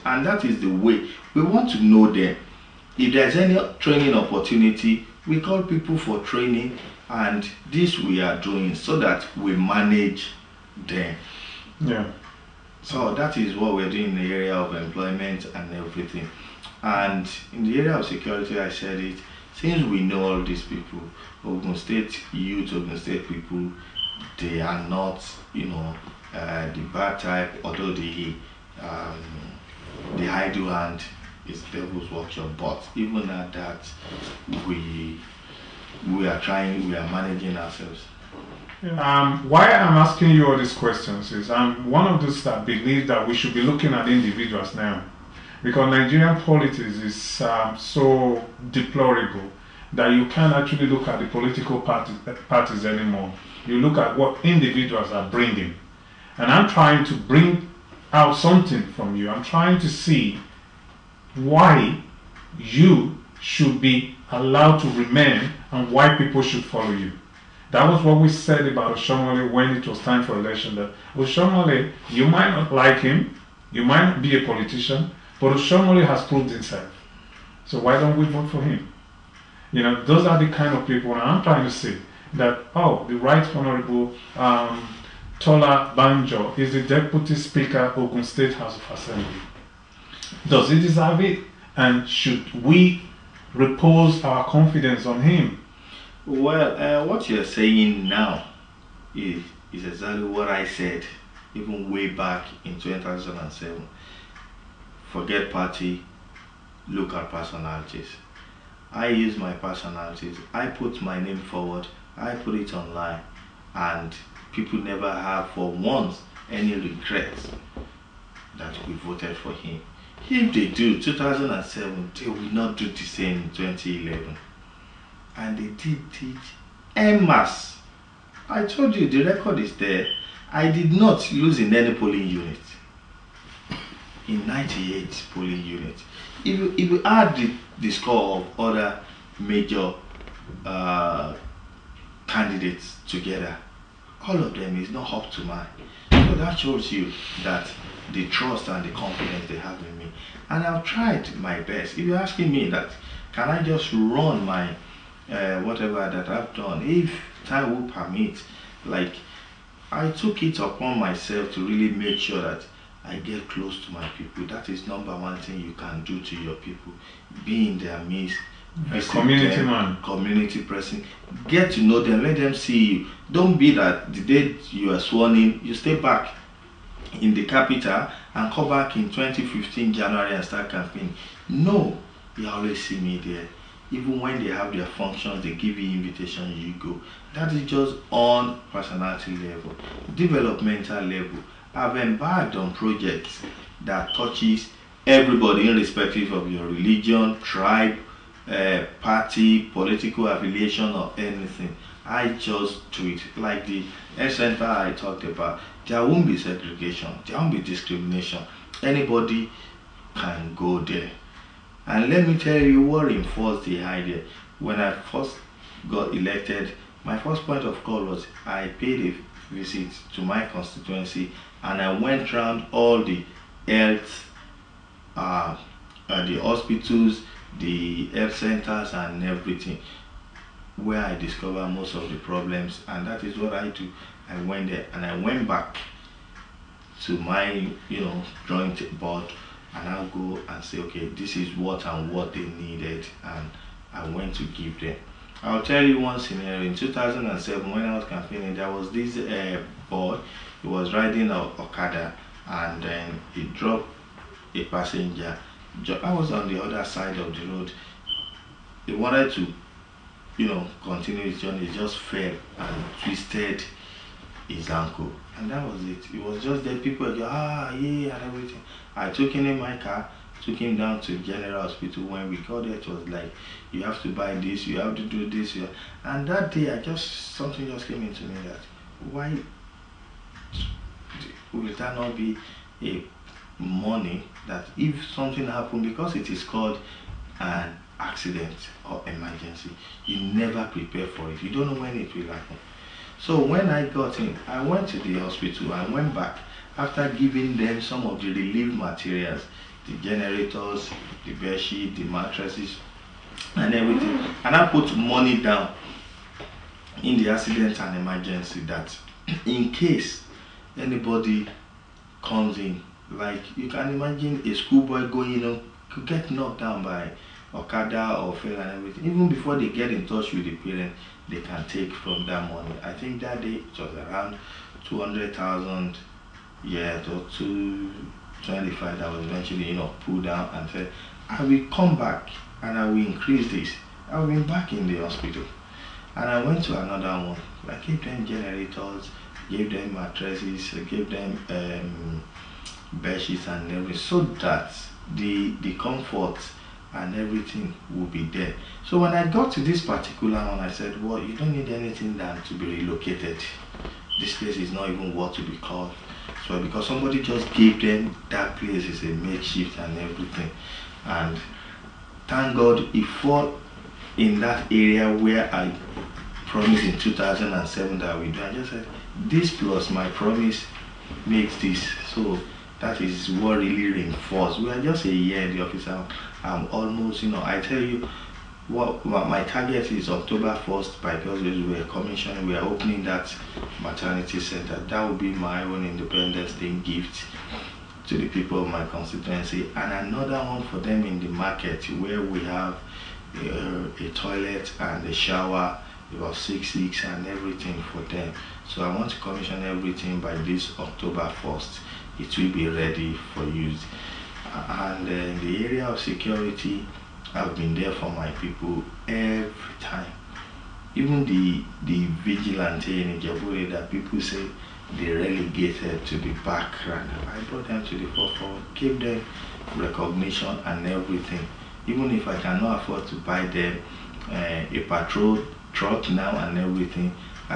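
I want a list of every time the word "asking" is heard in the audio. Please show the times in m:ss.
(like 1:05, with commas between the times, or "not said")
0:39, 2:32.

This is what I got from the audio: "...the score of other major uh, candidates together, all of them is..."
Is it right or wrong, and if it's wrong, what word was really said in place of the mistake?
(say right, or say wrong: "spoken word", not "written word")
right.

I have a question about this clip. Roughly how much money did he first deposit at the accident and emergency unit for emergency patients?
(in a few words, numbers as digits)
200,000.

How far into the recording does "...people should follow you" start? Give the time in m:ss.
1:06.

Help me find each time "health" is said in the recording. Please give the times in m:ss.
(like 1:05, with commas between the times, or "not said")
3:43, 3:48.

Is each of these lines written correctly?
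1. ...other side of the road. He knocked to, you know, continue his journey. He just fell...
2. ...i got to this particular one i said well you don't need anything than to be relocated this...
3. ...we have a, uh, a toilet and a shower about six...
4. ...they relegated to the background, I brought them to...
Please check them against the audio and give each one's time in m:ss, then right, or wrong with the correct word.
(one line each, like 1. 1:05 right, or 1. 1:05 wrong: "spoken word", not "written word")
1. 4:16 wrong: "wanted", not "knocked"
2. 5:49 right
3. 6:32 right
4. 6:54 right.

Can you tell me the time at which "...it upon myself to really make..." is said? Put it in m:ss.
2:40.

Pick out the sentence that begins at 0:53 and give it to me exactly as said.
You look at what individuals are bringing.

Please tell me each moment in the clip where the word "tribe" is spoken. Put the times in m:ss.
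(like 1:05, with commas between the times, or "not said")
3:17.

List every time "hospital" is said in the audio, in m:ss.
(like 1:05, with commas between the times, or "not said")
3:46, 4:31, 4:55, 5:34.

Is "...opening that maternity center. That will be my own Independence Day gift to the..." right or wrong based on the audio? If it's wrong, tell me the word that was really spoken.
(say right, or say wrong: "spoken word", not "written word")
right.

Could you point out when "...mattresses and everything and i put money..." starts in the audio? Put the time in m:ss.
5:02.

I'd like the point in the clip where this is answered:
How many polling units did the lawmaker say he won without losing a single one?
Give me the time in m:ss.
2:14.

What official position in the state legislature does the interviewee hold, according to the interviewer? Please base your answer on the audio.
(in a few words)
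Deputy Speaker.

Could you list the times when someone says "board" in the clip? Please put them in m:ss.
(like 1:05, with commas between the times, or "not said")
3:58.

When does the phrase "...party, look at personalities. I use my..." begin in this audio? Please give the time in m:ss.
1:45.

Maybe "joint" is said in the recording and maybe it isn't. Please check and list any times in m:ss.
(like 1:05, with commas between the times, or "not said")
3:58.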